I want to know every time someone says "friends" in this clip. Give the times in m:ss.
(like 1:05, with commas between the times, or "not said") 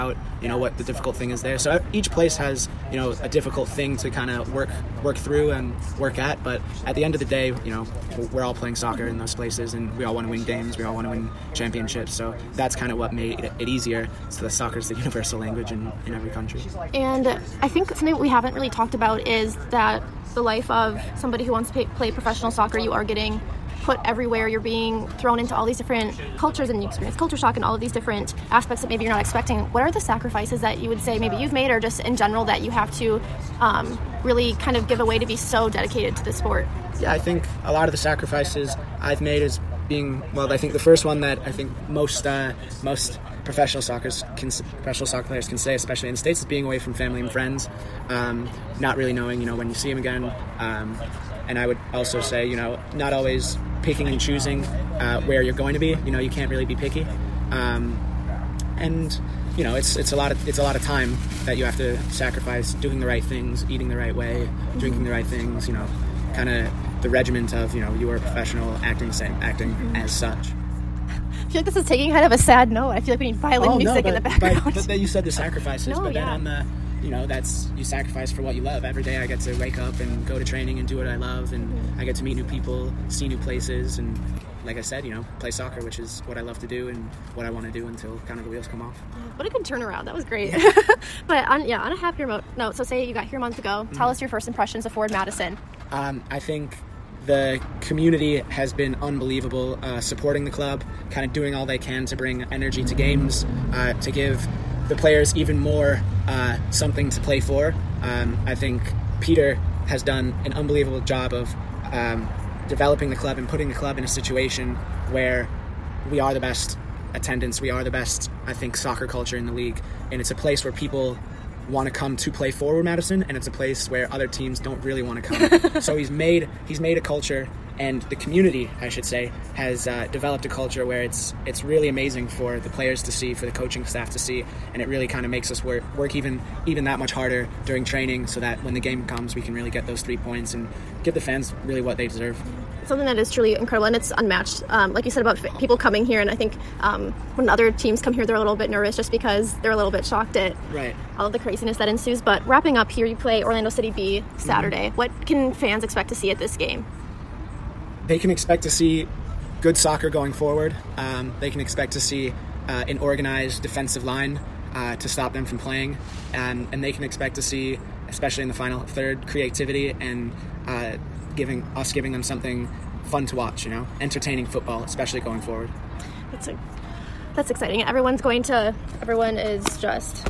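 0:47.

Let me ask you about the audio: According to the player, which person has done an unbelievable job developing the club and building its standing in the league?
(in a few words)
Peter.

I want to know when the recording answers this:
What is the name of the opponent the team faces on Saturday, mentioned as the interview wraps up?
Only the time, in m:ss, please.
2:33.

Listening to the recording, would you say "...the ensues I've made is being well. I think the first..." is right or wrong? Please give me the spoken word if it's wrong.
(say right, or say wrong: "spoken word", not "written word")
wrong: "sacrifices", not "ensues".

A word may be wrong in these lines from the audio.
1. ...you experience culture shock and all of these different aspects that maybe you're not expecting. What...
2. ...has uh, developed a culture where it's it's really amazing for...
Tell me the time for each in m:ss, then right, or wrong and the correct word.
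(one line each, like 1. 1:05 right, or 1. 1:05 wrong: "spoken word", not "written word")
1. 0:26 right
2. 2:09 right.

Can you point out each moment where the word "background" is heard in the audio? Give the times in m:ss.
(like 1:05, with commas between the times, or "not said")
1:14.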